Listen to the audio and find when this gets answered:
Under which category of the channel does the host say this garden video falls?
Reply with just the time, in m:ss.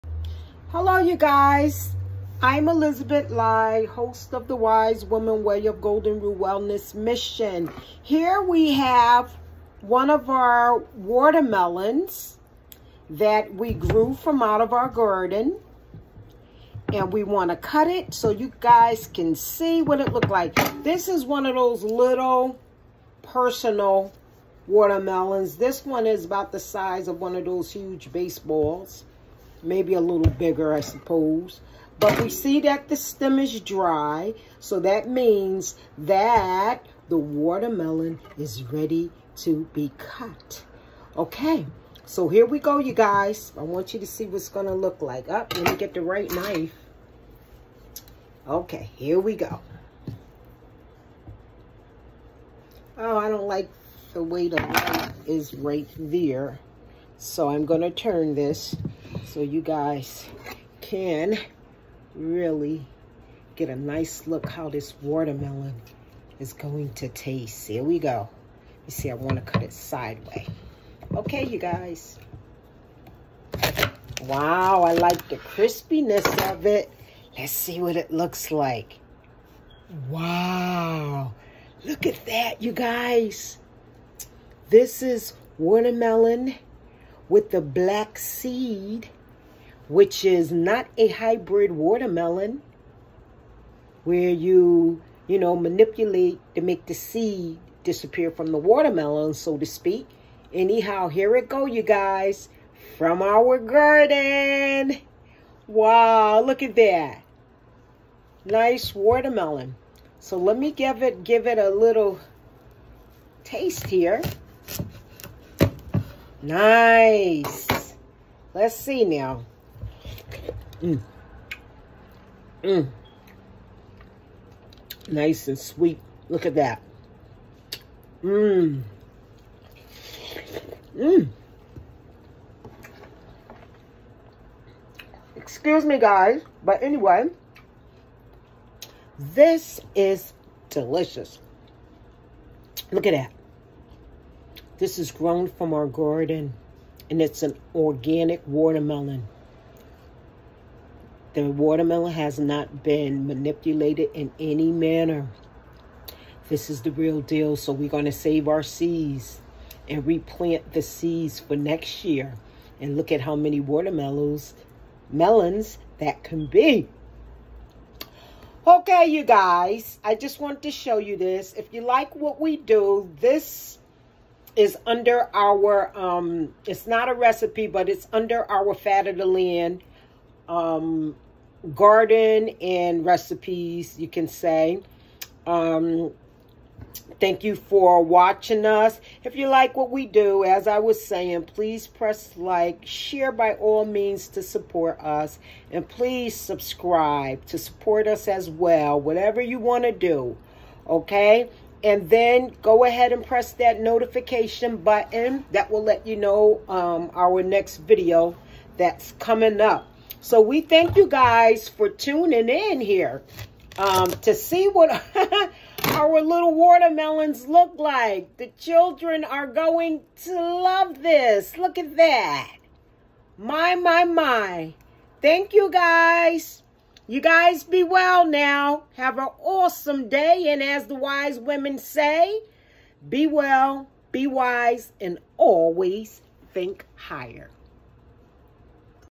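2:58.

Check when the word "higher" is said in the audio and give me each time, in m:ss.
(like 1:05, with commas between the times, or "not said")
3:56.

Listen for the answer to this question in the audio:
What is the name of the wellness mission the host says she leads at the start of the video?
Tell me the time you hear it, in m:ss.
0:04.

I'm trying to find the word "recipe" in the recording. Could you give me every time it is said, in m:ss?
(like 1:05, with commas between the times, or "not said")
2:57, 3:03.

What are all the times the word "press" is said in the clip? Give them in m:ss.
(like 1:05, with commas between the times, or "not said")
3:11, 3:23.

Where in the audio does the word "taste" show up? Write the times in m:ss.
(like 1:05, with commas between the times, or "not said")
1:07, 1:53.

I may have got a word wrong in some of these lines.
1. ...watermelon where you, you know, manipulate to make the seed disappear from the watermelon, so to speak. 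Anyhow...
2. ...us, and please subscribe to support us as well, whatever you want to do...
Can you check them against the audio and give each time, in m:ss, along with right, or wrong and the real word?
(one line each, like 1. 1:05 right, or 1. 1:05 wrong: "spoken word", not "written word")
1. 1:31 right
2. 3:14 right.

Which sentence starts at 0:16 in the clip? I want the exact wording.
And we want to cut it so you guys can see what it looked like.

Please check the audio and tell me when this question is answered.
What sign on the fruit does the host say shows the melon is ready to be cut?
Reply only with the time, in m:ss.
0:32.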